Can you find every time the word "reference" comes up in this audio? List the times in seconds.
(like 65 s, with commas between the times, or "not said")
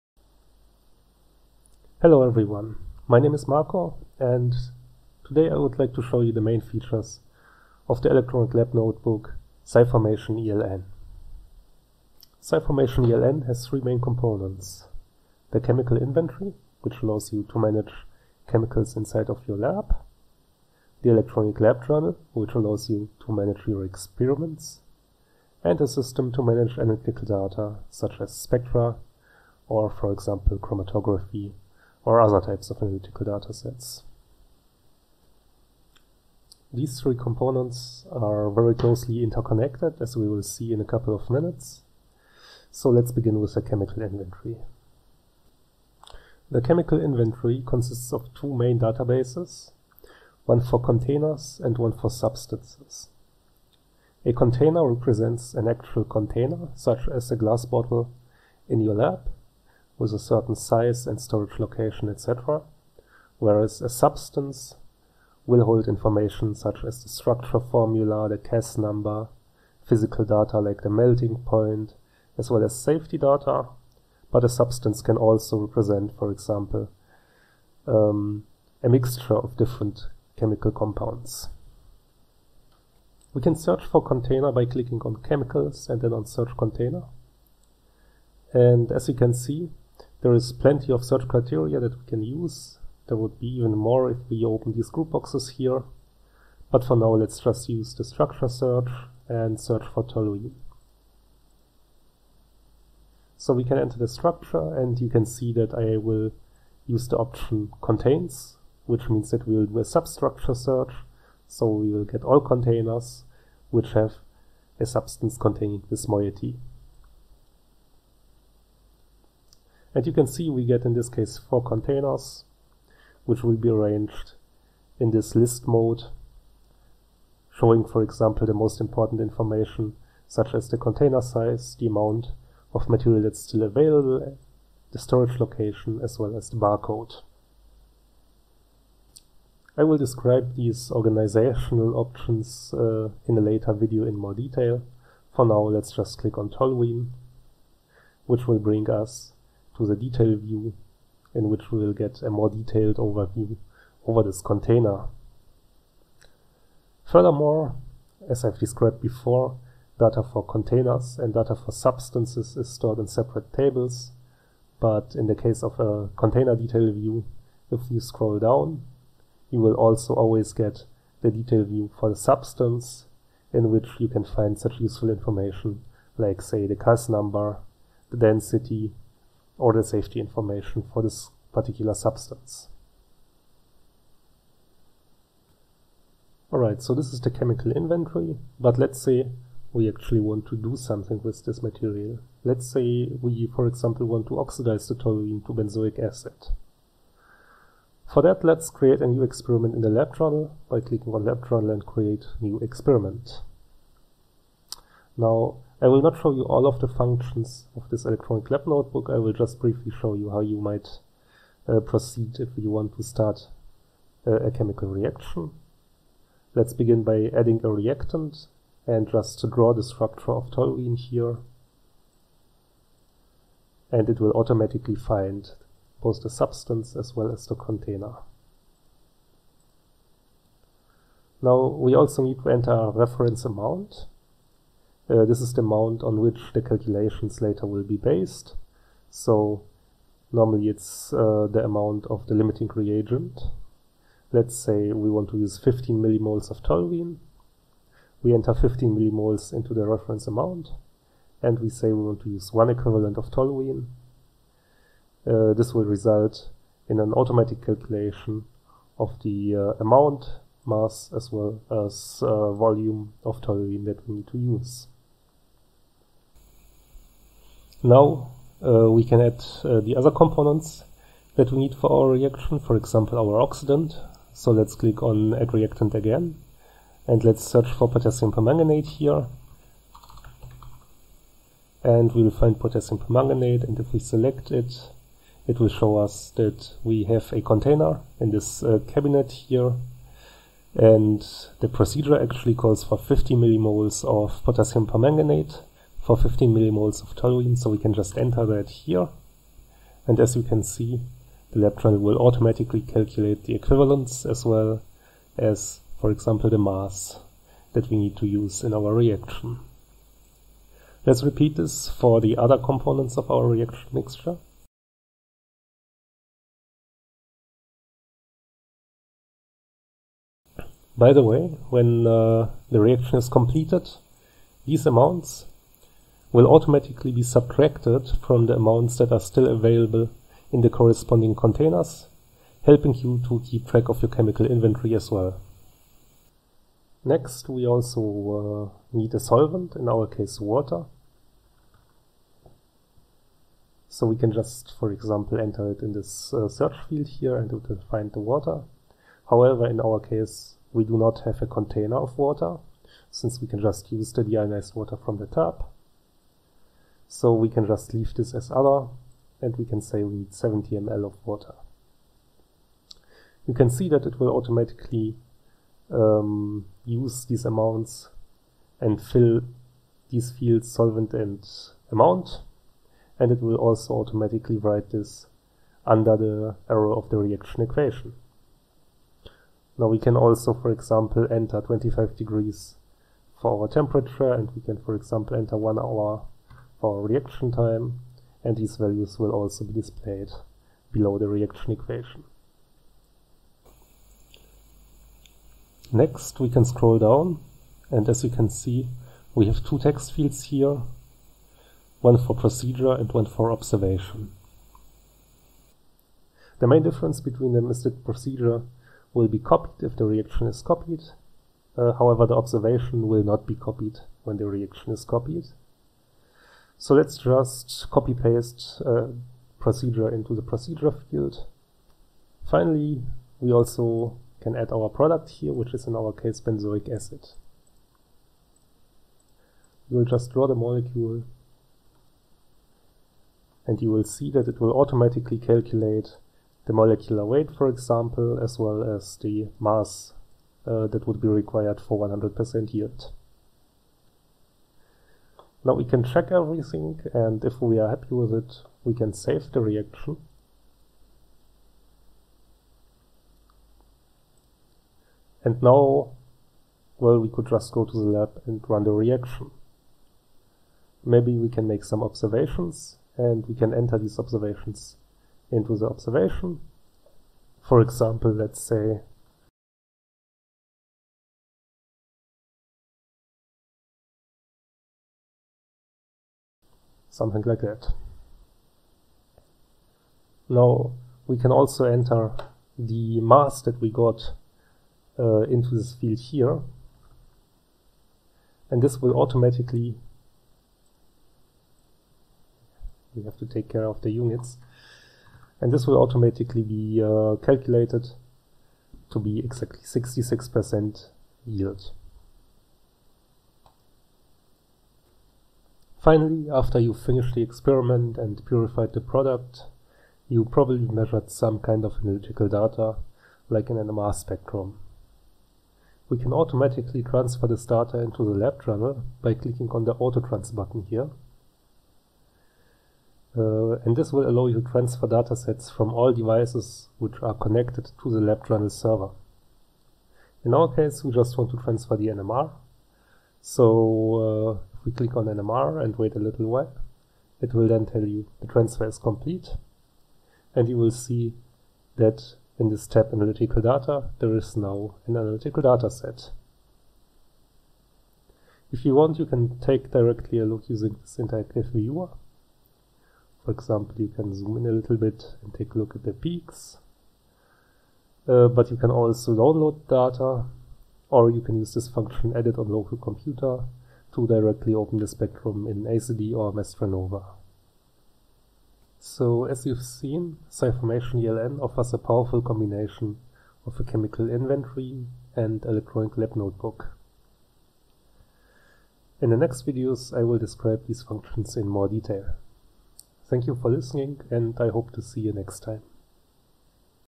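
232 s, 249 s.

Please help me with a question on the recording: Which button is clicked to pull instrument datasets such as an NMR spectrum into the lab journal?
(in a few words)
Autotrans.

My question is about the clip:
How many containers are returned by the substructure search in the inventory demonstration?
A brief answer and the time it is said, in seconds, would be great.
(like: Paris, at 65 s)
4, at 121 s.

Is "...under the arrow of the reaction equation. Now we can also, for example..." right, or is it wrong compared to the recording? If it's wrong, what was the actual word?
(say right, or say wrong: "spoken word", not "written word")
right.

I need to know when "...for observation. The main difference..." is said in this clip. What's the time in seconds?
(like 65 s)
403 s.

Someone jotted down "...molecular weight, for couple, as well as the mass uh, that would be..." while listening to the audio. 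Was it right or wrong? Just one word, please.
wrong.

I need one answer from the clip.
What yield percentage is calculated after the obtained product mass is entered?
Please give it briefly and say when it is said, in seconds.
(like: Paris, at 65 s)
66%, at 499 s.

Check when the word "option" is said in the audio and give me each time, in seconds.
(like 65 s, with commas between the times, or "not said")
107 s, 141 s.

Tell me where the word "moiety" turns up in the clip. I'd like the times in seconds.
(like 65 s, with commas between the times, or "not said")
116 s.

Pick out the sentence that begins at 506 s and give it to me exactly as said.
Finally, after you finished the experiment and purified the product, you probably measured some kind of analytical data, like an NMR spectrum.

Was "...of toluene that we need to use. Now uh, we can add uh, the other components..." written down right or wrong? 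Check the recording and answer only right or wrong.
right.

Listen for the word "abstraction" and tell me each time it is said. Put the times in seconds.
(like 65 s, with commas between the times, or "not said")
not said.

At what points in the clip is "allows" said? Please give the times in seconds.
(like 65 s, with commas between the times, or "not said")
17 s, 22 s, 524 s.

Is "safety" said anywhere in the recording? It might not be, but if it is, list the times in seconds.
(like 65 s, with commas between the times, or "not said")
72 s, 179 s.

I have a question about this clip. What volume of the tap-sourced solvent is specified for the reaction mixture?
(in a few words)
70 ml.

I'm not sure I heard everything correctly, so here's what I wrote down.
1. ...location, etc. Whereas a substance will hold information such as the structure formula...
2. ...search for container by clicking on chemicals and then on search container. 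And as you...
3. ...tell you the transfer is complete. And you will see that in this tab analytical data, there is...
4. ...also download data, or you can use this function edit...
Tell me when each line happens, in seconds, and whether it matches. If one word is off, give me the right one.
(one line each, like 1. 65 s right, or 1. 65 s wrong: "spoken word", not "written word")
1. 61 s right
2. 83 s right
3. 537 s right
4. 558 s right.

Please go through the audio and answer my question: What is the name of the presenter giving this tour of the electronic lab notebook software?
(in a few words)
Marco.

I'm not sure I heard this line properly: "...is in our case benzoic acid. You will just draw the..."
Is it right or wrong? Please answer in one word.
right.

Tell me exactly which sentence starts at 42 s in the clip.
So let's begin with the chemical inventory.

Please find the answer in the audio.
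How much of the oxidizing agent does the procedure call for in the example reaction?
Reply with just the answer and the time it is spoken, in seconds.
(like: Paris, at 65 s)
50 millimoles, at 292 s.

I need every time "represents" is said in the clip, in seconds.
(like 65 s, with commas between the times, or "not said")
54 s, 75 s.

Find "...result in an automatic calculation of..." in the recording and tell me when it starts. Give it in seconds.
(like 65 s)
255 s.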